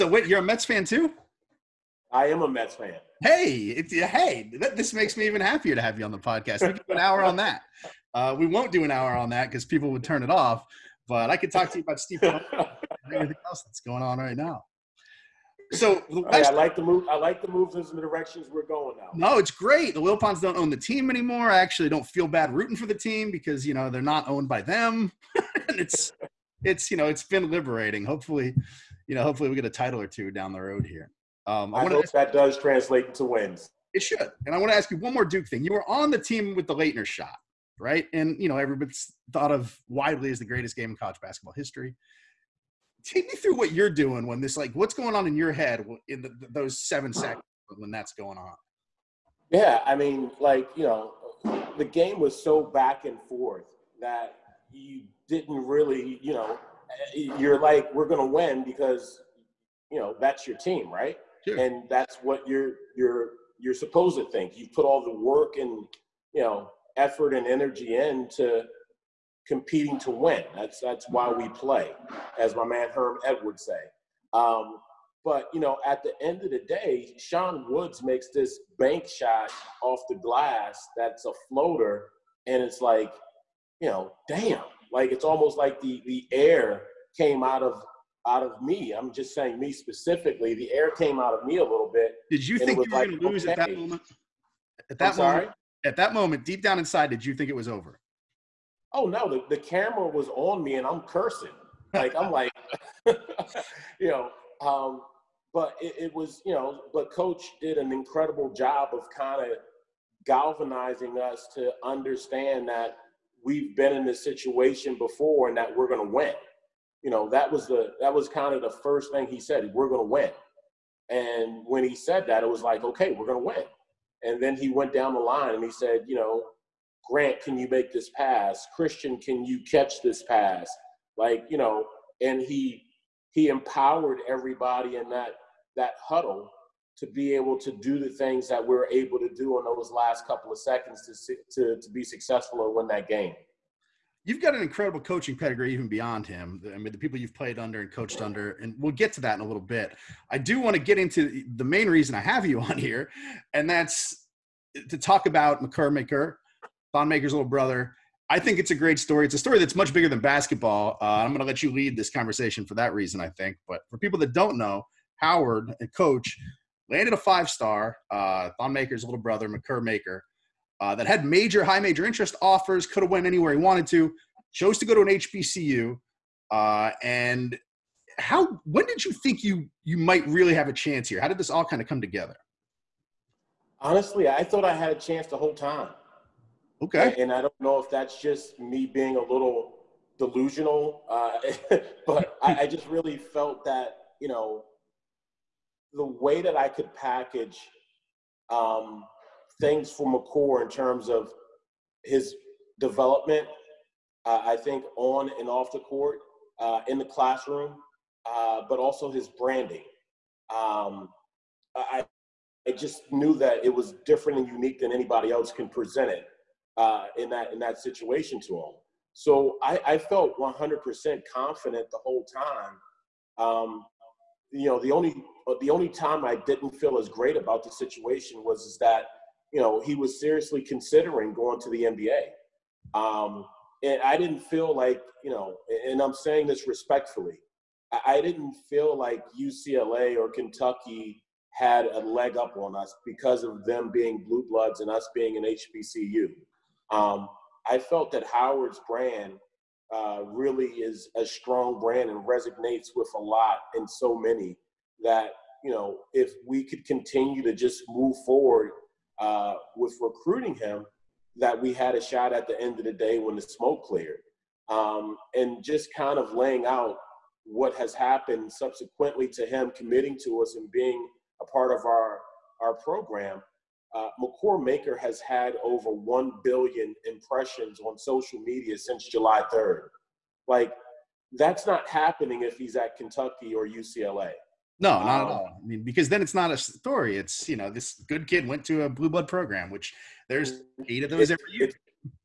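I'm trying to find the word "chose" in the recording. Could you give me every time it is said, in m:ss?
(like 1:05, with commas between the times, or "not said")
2:54.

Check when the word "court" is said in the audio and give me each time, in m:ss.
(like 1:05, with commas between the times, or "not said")
3:25.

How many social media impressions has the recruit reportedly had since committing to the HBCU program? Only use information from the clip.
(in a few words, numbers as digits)
Over 1 billion.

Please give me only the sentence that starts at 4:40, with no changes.
Like, that's not happening if he's at Kentucky or UCLA.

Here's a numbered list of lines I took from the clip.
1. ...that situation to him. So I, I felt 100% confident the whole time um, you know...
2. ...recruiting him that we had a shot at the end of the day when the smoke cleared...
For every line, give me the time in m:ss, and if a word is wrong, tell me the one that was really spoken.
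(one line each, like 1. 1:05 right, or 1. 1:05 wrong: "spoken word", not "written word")
1. 3:37 right
2. 4:20 right.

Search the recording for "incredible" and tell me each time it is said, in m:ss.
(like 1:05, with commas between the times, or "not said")
1:47, 2:24.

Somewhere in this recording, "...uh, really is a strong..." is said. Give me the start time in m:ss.
4:09.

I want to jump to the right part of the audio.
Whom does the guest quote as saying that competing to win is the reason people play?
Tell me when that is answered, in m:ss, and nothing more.
1:12.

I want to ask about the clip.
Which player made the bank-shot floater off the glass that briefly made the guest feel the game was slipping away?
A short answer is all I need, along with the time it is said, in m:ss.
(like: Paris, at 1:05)
Sean Woods, at 1:17.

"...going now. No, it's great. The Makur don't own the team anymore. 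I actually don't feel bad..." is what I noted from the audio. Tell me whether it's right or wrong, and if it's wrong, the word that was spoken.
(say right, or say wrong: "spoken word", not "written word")
wrong: "Wilpons", not "Makur".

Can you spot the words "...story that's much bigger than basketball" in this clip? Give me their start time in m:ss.
2:39.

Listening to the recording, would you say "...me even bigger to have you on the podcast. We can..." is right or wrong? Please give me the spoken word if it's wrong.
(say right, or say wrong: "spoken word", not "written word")
wrong: "happier", not "bigger".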